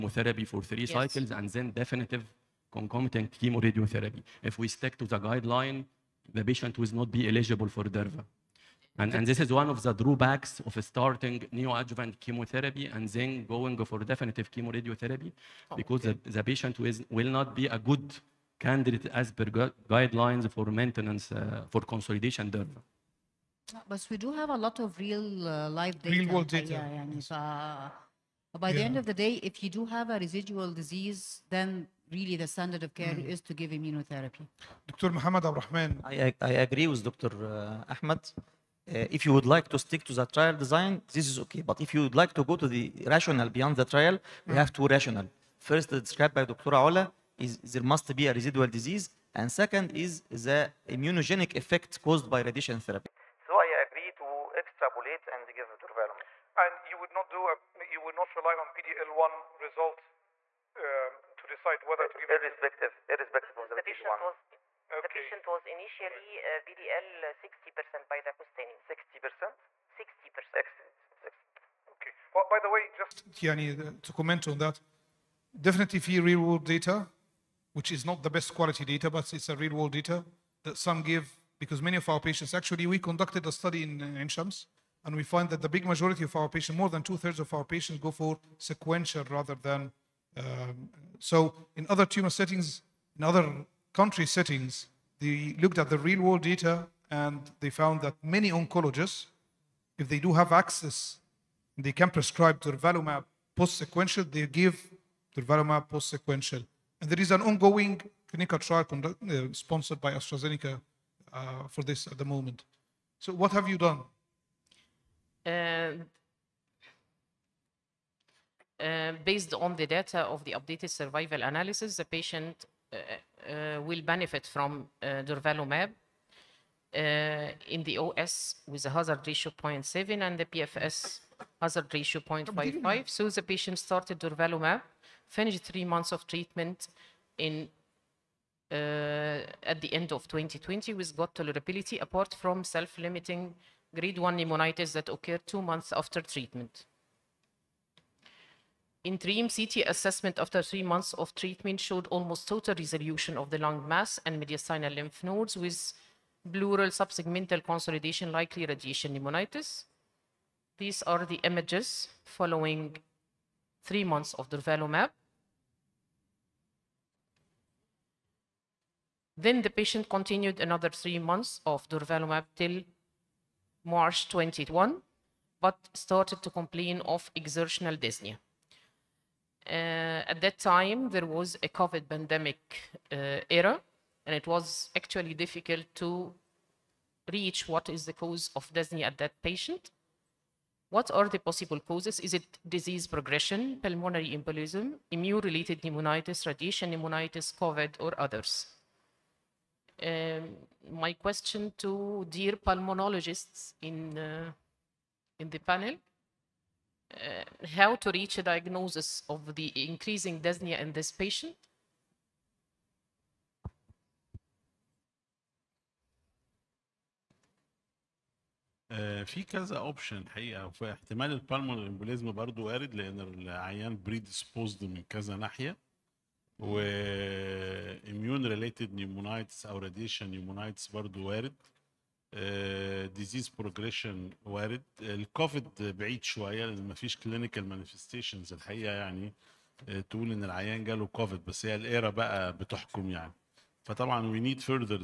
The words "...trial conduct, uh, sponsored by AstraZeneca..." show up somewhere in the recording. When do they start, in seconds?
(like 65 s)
108 s.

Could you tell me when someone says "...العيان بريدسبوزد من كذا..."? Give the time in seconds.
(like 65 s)
223 s.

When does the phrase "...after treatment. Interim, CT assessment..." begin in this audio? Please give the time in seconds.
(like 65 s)
145 s.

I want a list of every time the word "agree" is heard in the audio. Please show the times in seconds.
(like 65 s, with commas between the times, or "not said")
36 s, 53 s.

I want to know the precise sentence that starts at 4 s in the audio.
If we stick to the guideline, the patient will not be eligible for Durva.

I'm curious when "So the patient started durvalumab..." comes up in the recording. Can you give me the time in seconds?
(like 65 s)
133 s.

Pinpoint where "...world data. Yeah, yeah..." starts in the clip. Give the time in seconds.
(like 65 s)
26 s.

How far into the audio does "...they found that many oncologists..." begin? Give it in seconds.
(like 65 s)
97 s.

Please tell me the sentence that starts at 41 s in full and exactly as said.
But if you would like to go to the rational beyond the trial, we mm.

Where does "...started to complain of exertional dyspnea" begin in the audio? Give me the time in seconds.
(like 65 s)
175 s.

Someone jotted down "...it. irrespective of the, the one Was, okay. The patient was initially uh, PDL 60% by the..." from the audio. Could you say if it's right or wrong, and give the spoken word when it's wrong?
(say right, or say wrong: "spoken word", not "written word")
right.